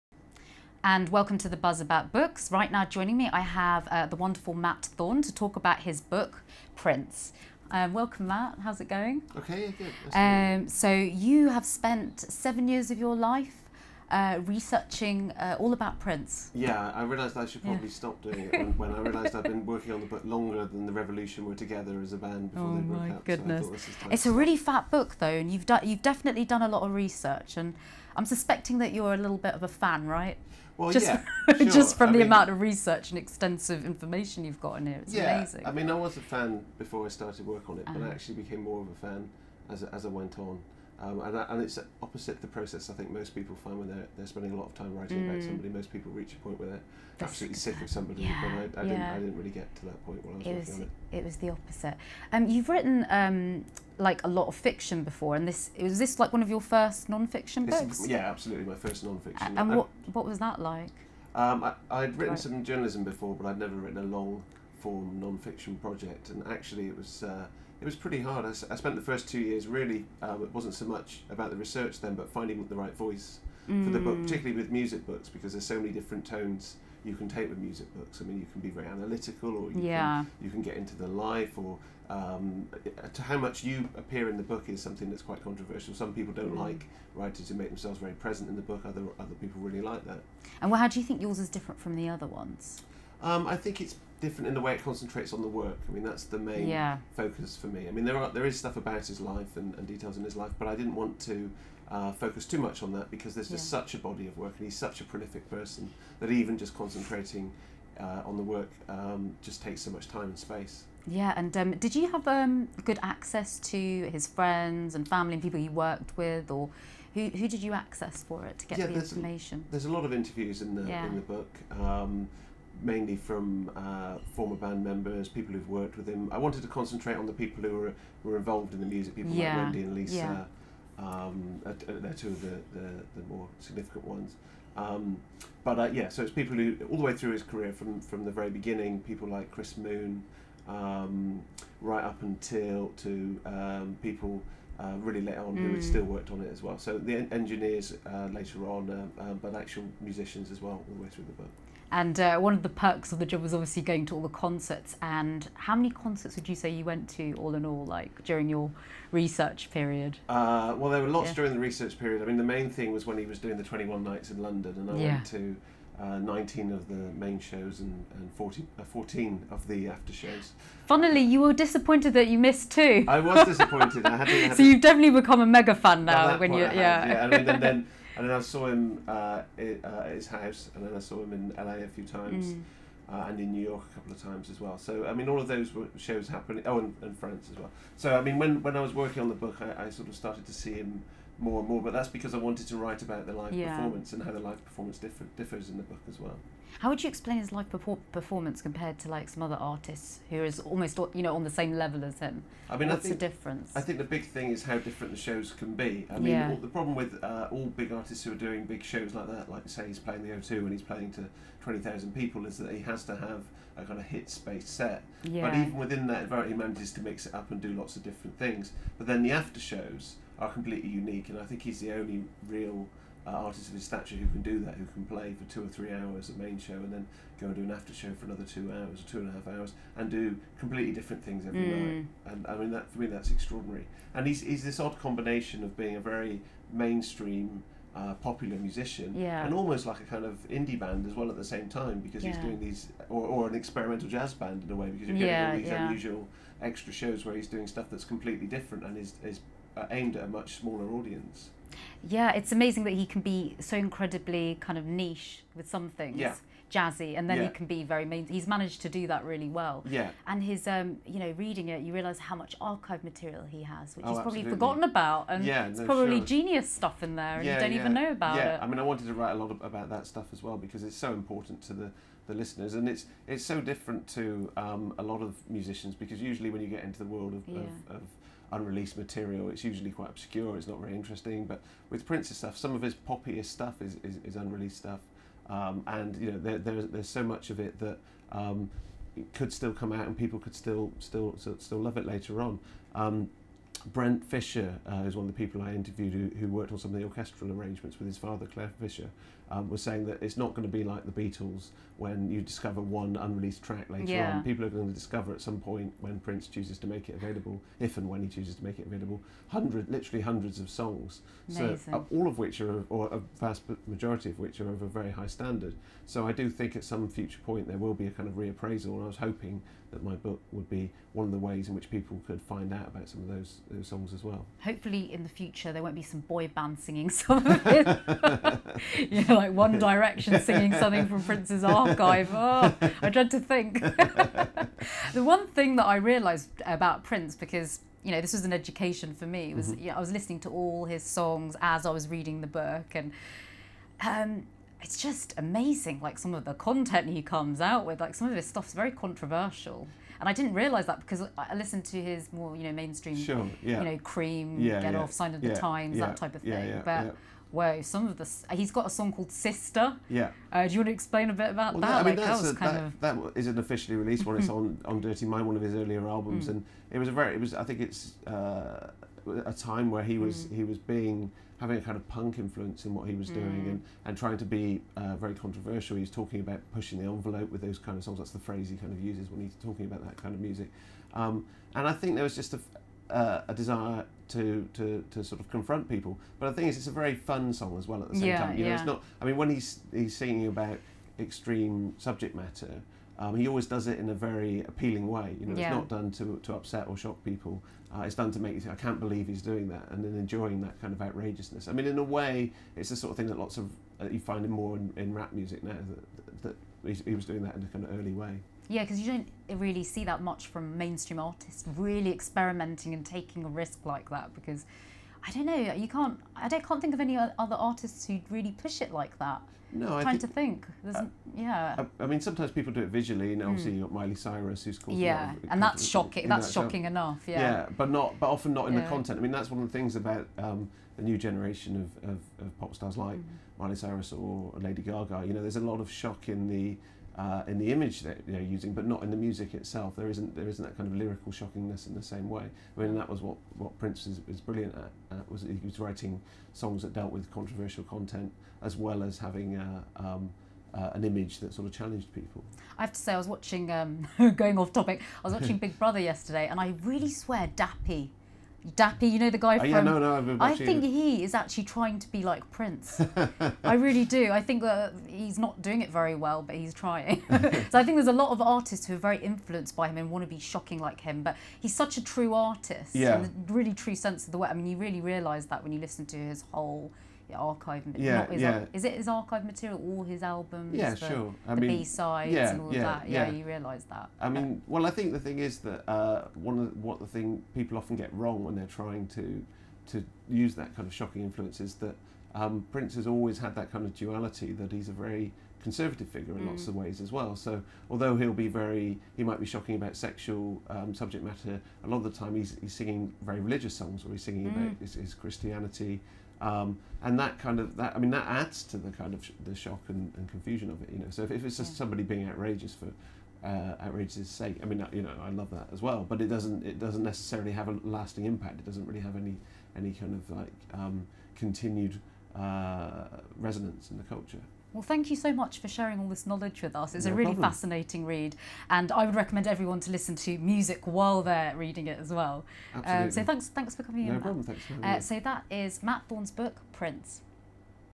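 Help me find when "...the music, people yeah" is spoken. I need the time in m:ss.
2:08.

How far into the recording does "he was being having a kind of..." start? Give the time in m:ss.
6:10.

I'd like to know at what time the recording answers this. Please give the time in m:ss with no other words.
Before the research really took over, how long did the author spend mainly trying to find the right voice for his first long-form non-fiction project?
1:09.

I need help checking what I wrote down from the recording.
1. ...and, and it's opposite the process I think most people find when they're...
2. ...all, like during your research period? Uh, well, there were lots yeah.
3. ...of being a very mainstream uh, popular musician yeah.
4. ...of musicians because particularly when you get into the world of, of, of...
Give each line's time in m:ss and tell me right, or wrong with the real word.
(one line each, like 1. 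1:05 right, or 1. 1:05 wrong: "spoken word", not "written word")
1. 0:41 right
2. 2:37 right
3. 3:55 right
4. 4:35 wrong: "usually", not "particularly".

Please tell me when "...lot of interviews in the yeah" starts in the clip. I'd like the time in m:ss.
1:59.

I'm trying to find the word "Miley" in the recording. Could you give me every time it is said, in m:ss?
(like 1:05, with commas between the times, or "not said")
7:03, 7:13.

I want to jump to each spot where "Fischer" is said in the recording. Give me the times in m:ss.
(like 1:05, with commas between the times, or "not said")
4:54, 4:58.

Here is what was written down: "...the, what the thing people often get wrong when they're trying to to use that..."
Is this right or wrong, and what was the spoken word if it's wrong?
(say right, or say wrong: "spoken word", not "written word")
right.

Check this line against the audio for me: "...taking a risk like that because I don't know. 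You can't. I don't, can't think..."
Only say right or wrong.
right.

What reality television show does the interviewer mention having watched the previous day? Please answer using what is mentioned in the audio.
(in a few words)
Big Brother.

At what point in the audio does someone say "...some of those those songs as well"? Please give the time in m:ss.
5:23.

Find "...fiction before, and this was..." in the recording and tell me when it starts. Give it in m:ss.
0:54.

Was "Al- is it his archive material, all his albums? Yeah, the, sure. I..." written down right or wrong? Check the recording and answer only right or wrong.
right.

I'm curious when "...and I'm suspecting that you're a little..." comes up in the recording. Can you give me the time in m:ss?
0:27.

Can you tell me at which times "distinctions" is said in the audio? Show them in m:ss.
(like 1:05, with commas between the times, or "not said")
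not said.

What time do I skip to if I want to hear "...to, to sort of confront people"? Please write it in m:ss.
6:24.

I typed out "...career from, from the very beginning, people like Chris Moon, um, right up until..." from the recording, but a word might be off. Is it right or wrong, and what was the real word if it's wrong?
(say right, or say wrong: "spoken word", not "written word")
right.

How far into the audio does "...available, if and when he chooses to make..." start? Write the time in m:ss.
5:07.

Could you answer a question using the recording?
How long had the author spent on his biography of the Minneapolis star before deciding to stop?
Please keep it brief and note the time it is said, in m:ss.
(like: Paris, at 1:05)
7 years, at 0:12.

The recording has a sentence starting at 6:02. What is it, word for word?
I mean, like, that, was a, kind that, of...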